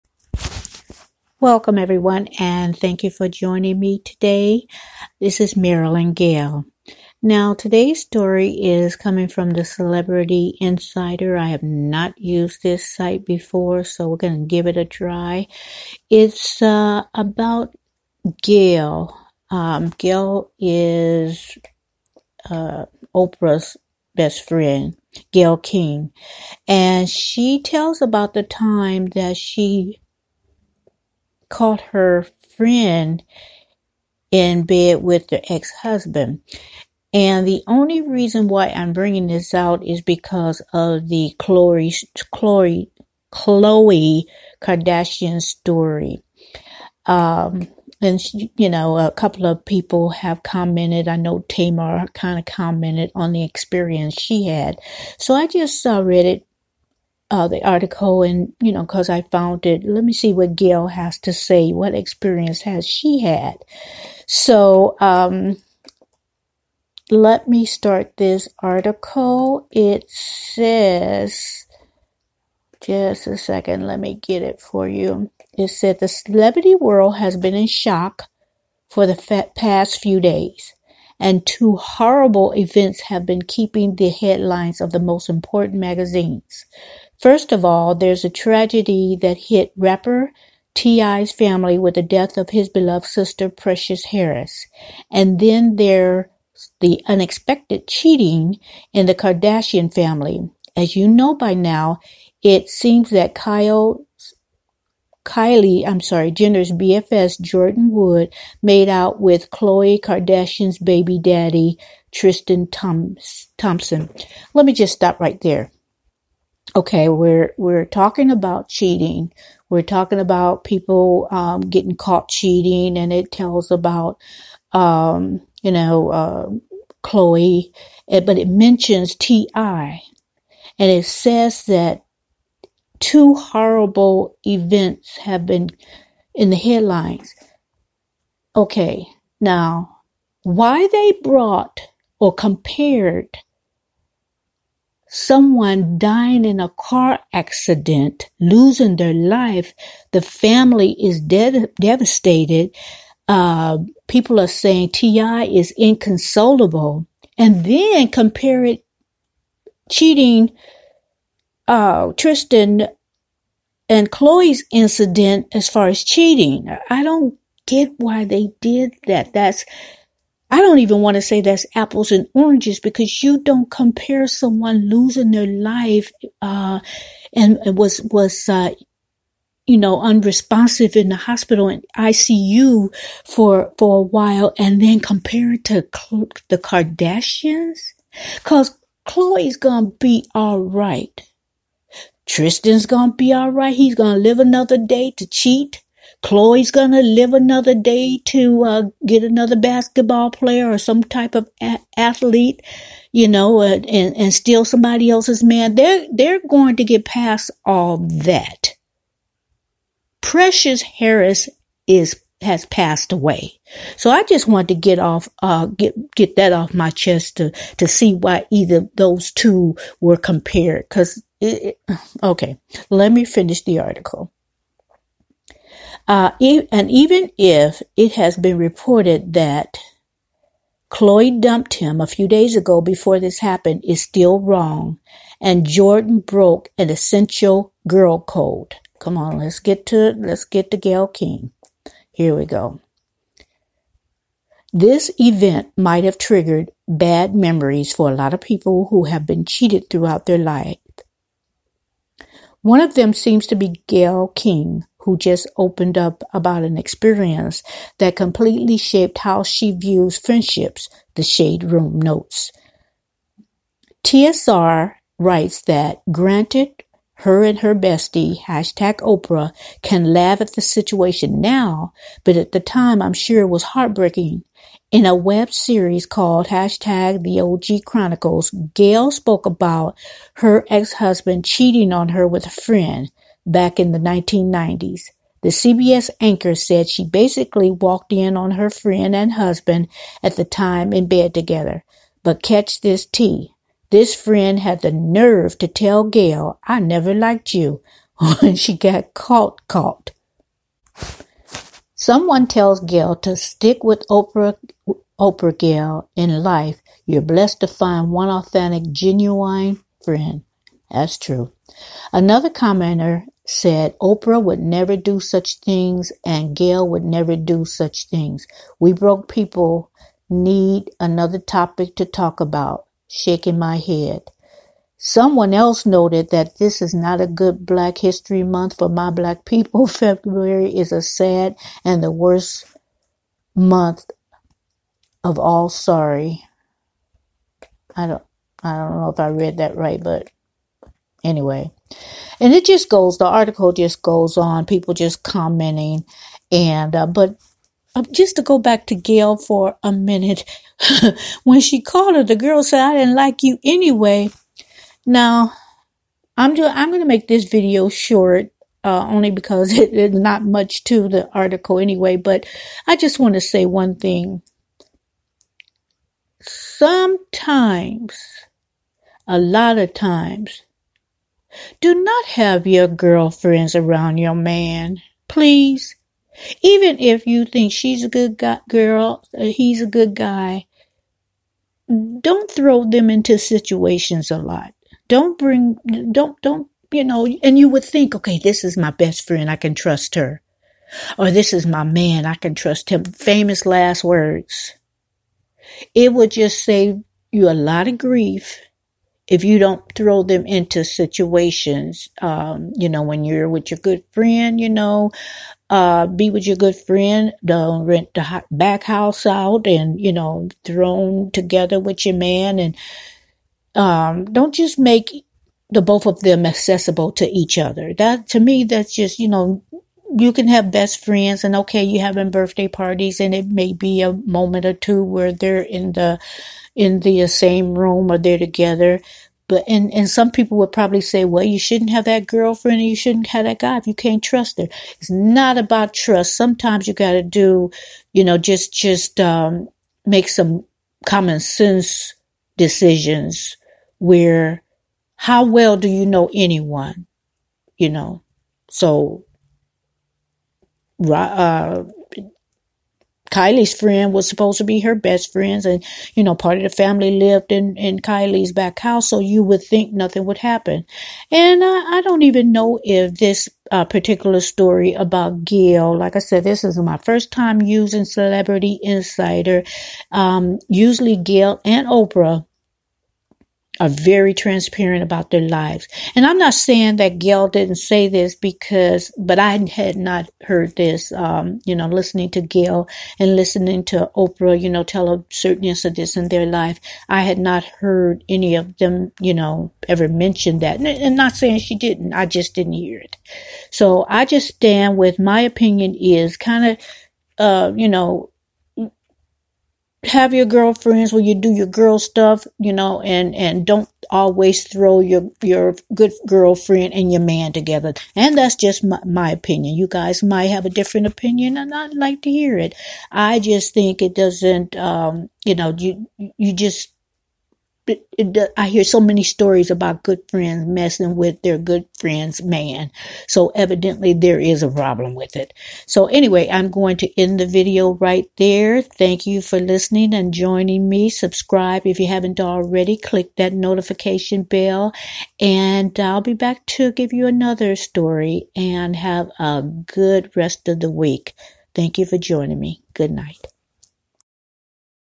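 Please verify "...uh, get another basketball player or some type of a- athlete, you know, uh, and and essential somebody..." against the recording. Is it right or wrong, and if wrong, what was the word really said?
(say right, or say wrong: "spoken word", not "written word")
wrong: "steal", not "essential".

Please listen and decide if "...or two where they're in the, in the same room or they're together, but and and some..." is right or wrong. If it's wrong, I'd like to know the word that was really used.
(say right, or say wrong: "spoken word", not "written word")
right.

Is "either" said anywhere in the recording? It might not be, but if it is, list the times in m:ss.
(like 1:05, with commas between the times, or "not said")
3:38.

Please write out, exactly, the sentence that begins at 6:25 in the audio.
Don't bring, don't, don't, you know, and you would think, okay, this is my best friend.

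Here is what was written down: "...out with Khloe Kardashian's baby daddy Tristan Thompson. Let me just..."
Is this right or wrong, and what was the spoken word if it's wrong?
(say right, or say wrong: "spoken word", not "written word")
right.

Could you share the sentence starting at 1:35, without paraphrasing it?
And then there's the unexpected cheating in the Kardashian family.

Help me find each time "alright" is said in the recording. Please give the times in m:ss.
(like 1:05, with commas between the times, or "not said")
3:10.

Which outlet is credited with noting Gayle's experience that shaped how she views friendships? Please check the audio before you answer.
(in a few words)
The Shade Room.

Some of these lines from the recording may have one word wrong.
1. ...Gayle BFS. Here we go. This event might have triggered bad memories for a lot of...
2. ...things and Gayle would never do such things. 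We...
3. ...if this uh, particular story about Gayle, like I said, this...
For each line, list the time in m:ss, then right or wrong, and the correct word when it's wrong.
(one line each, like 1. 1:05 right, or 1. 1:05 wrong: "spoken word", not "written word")
1. 4:00 wrong: "King", not "BFS"
2. 5:15 right
3. 7:42 right.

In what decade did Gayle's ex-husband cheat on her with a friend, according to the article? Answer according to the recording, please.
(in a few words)
1990s.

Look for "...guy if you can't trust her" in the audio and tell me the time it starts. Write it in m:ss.
7:13.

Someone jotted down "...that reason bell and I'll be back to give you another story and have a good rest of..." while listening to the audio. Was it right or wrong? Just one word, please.
wrong.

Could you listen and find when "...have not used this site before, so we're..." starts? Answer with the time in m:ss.
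0:11.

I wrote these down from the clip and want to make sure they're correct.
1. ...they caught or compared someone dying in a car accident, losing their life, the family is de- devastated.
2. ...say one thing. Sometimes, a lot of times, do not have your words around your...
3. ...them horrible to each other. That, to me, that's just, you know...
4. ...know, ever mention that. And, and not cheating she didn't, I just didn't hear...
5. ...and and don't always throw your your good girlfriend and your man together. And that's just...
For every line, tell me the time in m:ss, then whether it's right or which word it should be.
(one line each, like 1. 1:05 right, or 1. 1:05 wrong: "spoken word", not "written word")
1. 2:20 wrong: "brought", not "caught"
2. 6:03 wrong: "girlfriends", not "words"
3. 6:56 wrong: "accessible", not "horrible"
4. 8:09 wrong: "saying", not "cheating"
5. 8:23 right.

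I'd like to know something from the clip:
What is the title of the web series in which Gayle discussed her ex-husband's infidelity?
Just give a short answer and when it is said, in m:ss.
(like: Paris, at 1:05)
The OG Chronicles, at 4:37.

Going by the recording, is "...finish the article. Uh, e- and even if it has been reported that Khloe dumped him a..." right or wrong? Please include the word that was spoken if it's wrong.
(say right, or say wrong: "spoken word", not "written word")
right.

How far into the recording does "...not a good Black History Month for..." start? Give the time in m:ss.
5:26.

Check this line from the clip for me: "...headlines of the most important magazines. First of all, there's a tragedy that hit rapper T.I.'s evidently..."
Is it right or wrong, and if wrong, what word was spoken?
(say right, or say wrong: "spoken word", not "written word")
wrong: "family", not "evidently".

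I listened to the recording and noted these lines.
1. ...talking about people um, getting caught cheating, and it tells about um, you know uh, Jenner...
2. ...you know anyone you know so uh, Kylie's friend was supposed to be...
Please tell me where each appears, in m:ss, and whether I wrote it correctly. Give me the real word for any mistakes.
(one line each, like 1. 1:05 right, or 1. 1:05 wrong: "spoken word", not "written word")
1. 1:59 wrong: "Khloe", not "Jenner"
2. 7:25 right.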